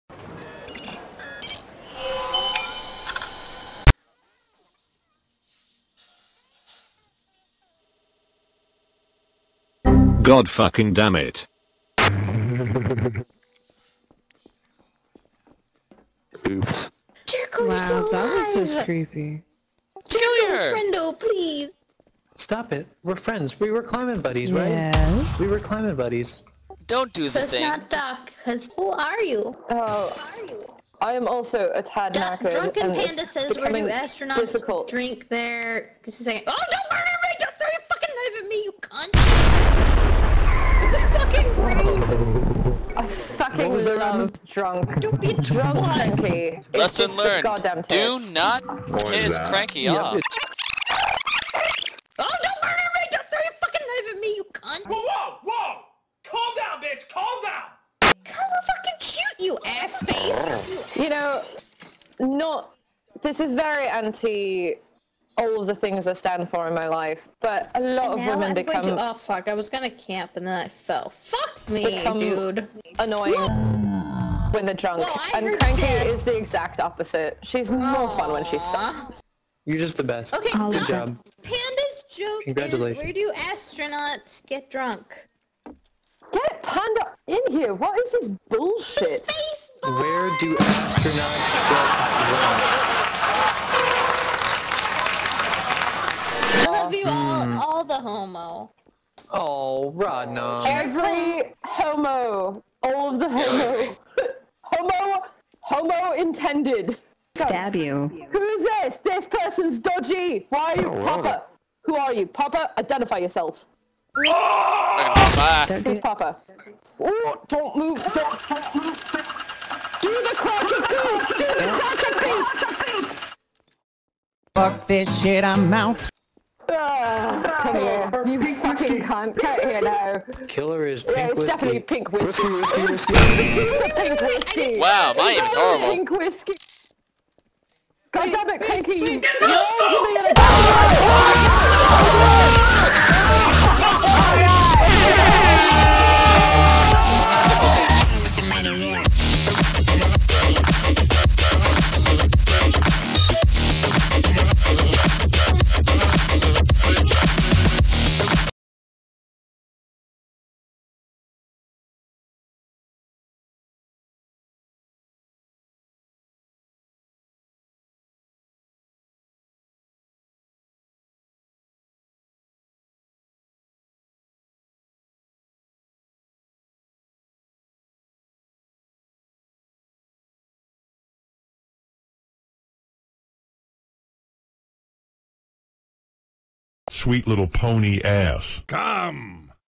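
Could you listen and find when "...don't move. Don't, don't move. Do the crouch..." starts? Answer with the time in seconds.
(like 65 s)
117 s.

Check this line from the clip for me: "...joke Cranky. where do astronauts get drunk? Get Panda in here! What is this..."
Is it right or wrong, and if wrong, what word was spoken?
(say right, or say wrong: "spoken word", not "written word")
wrong: "Congratulations", not "Cranky".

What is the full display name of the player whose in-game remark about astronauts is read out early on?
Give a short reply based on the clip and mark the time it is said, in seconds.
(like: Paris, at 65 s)
Drunken Panda, at 32 s.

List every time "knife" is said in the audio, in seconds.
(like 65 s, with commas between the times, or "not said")
38 s, 53 s.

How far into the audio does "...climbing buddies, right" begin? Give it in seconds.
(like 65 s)
23 s.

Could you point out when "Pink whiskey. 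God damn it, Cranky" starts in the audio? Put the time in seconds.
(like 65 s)
135 s.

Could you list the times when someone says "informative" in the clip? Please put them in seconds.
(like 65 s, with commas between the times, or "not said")
not said.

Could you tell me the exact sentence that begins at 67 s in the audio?
But a lot and of women I'm become.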